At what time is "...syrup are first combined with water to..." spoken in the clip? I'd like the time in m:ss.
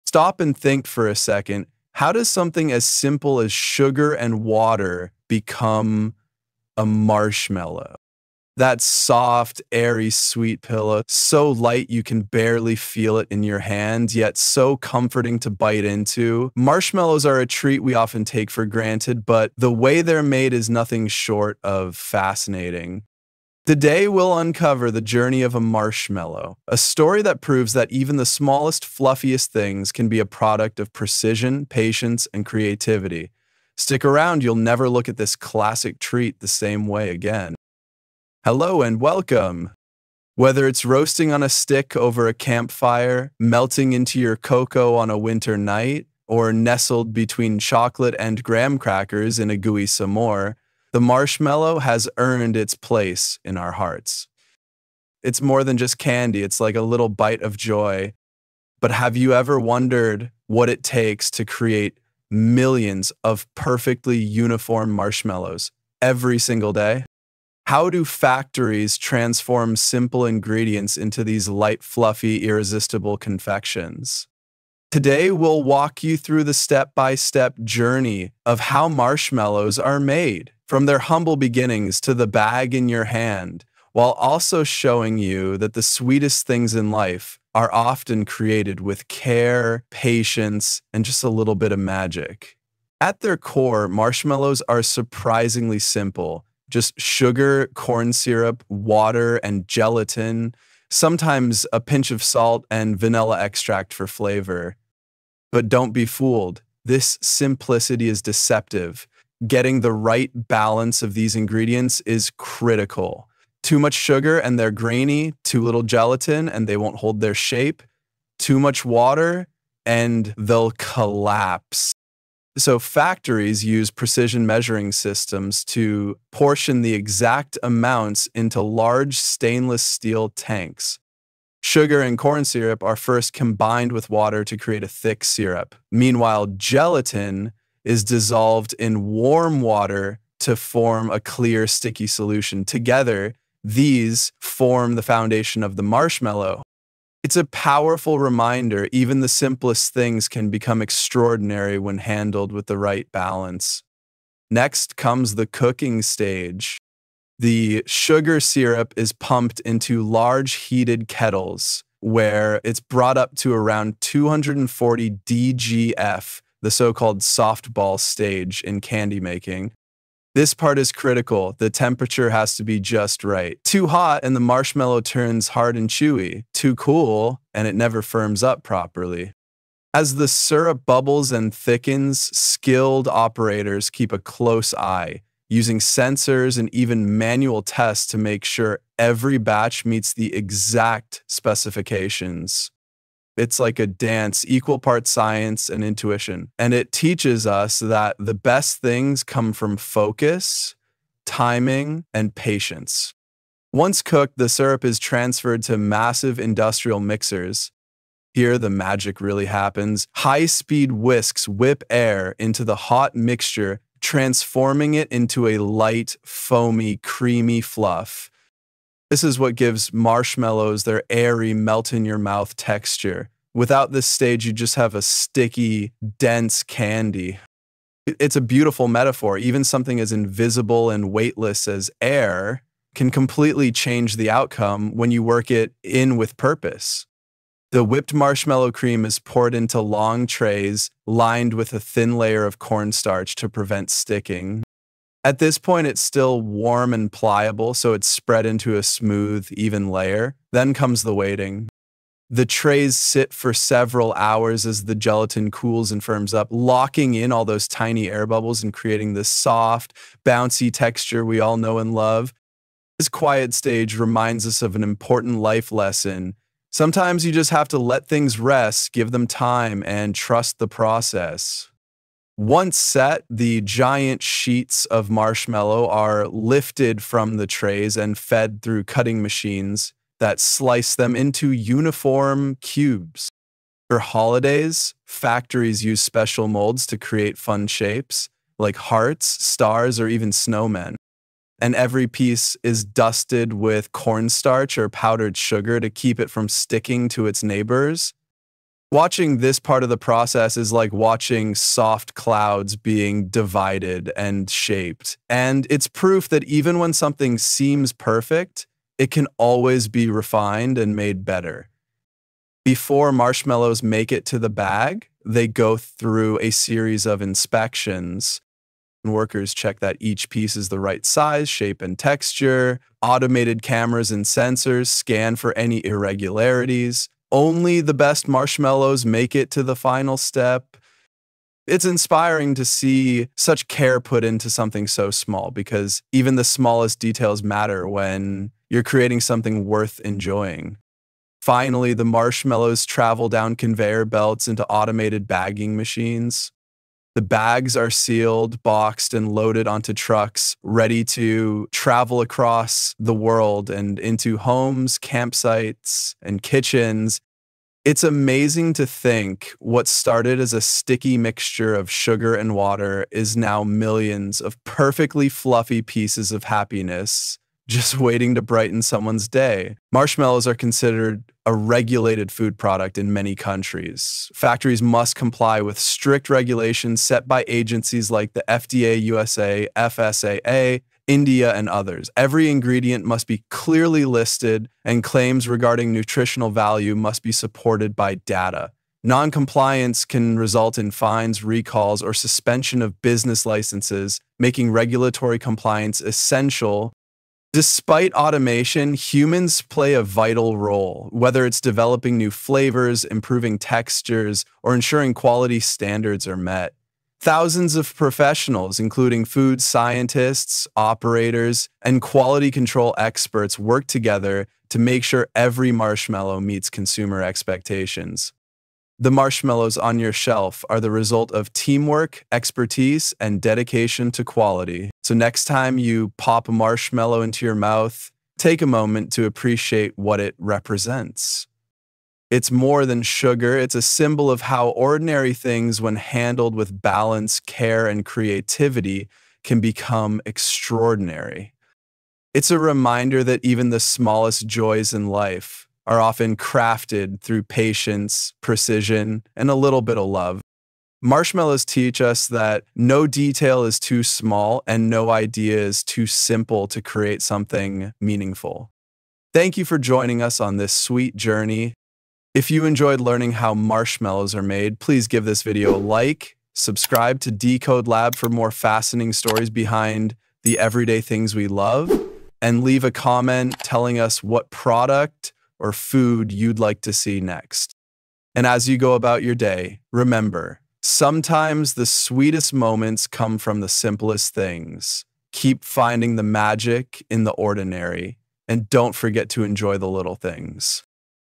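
2:12.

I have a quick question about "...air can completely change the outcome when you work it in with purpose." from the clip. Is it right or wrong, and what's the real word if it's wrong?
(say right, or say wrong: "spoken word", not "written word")
right.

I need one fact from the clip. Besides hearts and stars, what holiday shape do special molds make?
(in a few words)
snowmen.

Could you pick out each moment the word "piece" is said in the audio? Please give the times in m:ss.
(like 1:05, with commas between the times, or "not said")
4:52, 5:20, 6:05.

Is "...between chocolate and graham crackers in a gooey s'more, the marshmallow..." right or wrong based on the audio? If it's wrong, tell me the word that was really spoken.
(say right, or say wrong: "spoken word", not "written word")
right.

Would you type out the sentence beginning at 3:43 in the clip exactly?
Without this stage, you just have a sticky, dense candy.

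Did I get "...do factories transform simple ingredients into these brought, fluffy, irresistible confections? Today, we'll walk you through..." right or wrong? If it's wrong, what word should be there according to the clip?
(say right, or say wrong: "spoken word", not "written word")
wrong: "light", not "brought".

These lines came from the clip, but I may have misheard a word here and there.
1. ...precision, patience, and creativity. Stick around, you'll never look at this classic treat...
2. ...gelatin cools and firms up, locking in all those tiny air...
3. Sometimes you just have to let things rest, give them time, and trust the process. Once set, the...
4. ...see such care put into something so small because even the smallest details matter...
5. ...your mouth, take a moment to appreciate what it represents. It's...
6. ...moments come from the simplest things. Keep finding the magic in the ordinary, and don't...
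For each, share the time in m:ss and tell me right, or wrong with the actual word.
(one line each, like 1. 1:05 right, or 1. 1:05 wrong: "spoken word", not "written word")
1. 0:30 right
2. 4:14 right
3. 4:26 right
4. 5:32 right
5. 7:07 right
6. 8:02 right.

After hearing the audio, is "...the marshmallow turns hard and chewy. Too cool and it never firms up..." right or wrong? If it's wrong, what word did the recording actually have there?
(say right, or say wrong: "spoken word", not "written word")
right.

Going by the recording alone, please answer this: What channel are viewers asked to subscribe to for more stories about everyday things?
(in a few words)
Decode Lab.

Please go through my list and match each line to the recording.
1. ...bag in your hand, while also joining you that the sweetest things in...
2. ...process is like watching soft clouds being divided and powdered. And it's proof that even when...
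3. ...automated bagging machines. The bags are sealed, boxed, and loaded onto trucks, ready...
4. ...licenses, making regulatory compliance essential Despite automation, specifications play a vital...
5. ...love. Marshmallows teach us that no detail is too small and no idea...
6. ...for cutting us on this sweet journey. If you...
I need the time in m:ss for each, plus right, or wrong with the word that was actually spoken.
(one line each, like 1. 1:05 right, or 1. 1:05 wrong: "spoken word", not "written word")
1. 1:22 wrong: "showing", not "joining"
2. 4:59 wrong: "shaped", not "powdered"
3. 5:44 right
4. 6:33 wrong: "humans", not "specifications"
5. 7:30 right
6. 7:39 wrong: "joining", not "cutting".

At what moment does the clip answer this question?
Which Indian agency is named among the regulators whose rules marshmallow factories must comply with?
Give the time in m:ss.
6:19.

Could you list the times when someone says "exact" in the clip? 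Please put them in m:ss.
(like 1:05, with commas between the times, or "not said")
2:06, 3:10.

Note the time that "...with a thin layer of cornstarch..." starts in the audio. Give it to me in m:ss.
4:01.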